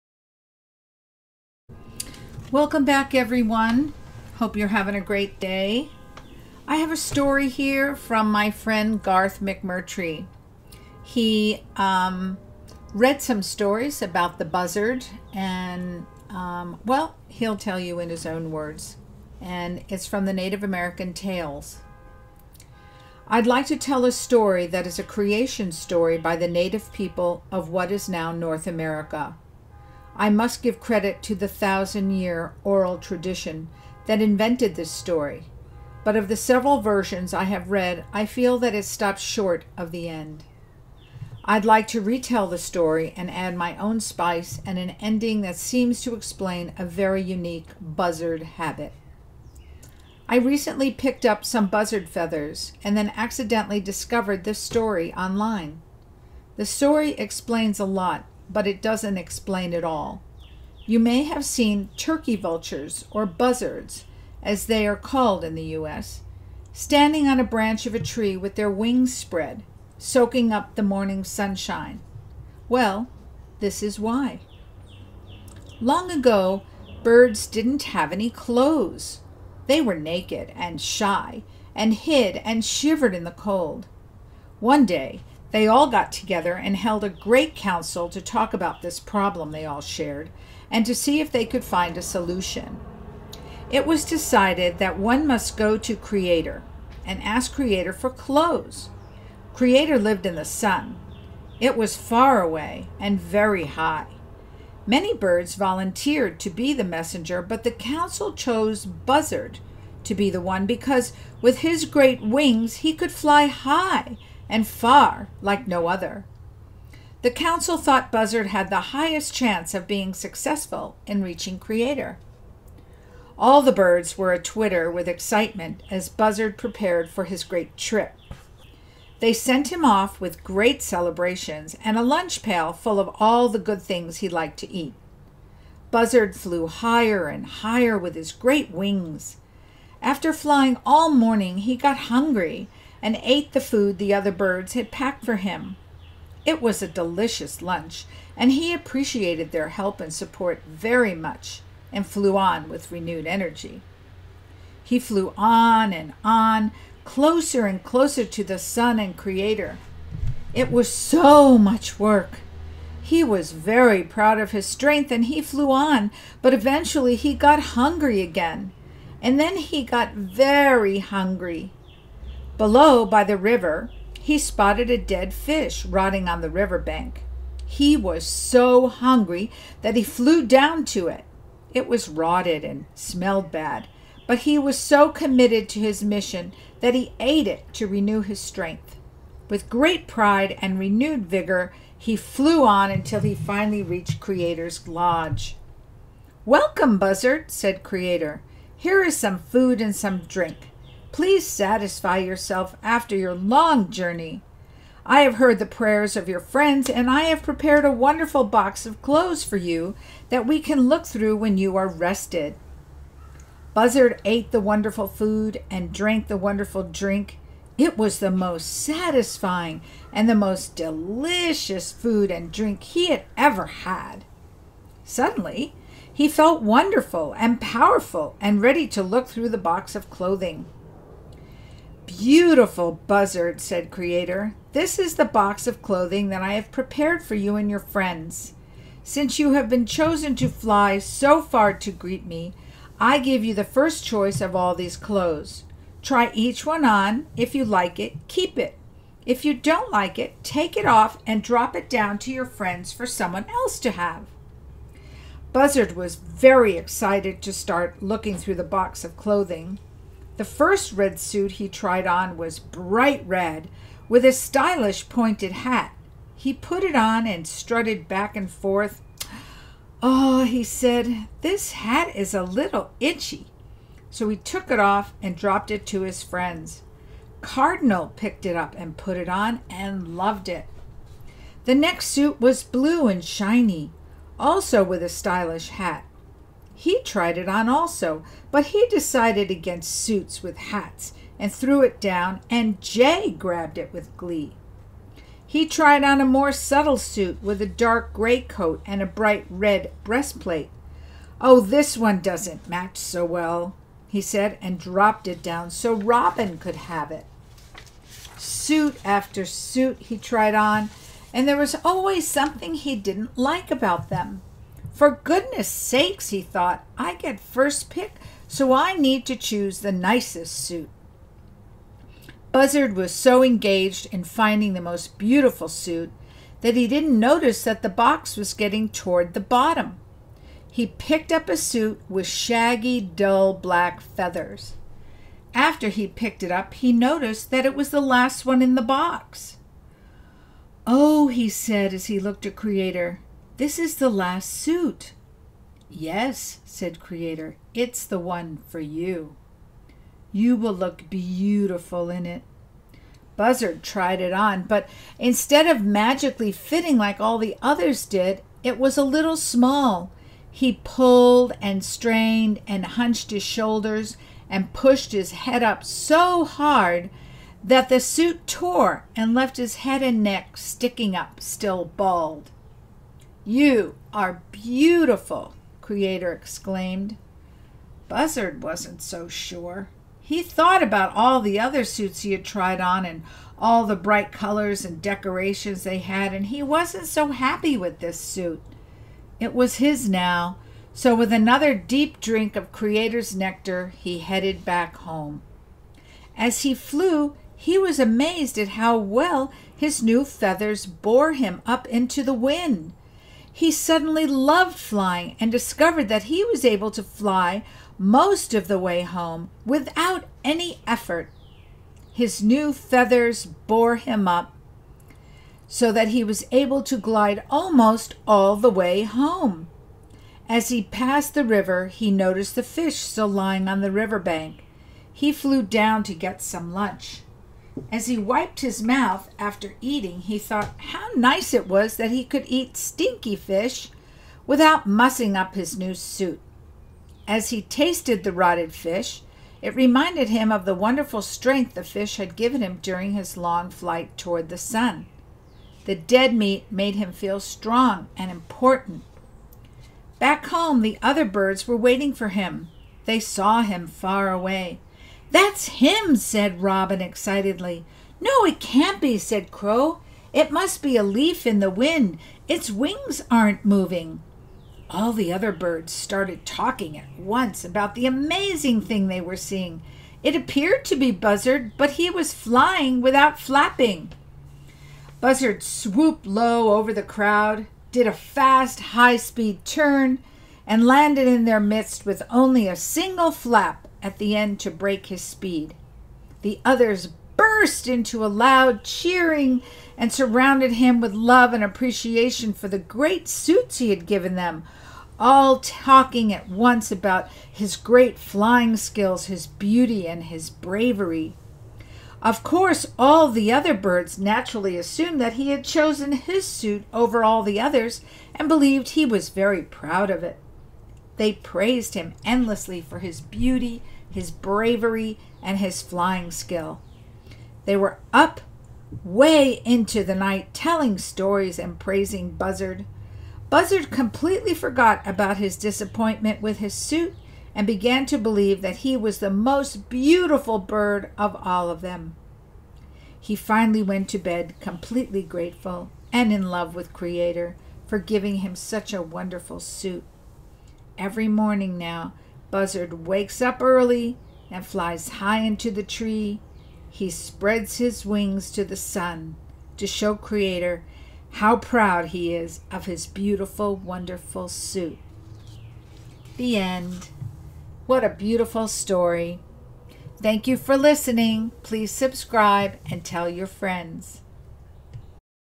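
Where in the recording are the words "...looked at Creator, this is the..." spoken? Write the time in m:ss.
5:42.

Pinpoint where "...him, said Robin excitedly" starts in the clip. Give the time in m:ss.
7:35.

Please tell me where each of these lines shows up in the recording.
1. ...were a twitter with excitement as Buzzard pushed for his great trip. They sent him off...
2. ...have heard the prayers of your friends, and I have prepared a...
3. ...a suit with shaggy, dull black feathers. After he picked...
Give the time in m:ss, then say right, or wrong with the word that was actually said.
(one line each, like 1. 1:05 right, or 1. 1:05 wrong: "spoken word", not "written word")
1. 2:04 wrong: "prepared", not "pushed"
2. 3:25 right
3. 5:31 right.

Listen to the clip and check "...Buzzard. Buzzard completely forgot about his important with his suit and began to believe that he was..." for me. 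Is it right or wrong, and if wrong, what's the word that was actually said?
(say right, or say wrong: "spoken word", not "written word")
wrong: "disappointment", not "important".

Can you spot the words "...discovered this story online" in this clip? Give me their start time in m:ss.
0:53.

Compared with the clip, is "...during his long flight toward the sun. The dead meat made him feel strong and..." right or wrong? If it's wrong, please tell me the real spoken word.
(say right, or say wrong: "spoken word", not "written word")
right.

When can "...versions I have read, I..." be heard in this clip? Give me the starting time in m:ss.
0:36.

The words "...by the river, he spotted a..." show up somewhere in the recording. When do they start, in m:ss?
2:53.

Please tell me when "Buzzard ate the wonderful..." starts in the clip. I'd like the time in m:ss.
3:33.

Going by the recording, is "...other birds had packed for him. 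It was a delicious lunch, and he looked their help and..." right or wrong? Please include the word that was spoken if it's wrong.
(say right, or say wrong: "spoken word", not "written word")
wrong: "appreciated", not "looked".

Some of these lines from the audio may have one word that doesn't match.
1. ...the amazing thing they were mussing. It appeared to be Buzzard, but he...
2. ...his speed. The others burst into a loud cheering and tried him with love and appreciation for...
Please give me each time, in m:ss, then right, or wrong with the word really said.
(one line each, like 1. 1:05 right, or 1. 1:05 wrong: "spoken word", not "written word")
1. 7:47 wrong: "seeing", not "mussing"
2. 8:05 wrong: "surrounded", not "tried".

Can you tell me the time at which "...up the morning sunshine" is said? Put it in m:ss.
1:10.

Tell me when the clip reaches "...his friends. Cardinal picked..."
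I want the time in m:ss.
4:36.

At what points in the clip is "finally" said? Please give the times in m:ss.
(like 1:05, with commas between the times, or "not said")
3:13, 8:53.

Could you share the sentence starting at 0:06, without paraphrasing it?
I have a story here from my friend Garth McMurtry.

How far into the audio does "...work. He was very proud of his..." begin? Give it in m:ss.
2:41.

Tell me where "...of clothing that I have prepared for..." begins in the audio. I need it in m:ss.
3:55.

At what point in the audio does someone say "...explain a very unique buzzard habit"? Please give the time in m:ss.
0:46.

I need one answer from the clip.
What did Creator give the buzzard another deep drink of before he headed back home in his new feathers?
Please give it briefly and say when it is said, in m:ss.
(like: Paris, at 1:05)
nectar, at 6:33.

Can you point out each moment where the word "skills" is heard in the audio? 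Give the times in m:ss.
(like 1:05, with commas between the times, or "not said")
8:18, 8:36.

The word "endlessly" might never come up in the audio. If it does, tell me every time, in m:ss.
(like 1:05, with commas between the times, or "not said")
8:32.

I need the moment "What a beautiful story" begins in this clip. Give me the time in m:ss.
9:17.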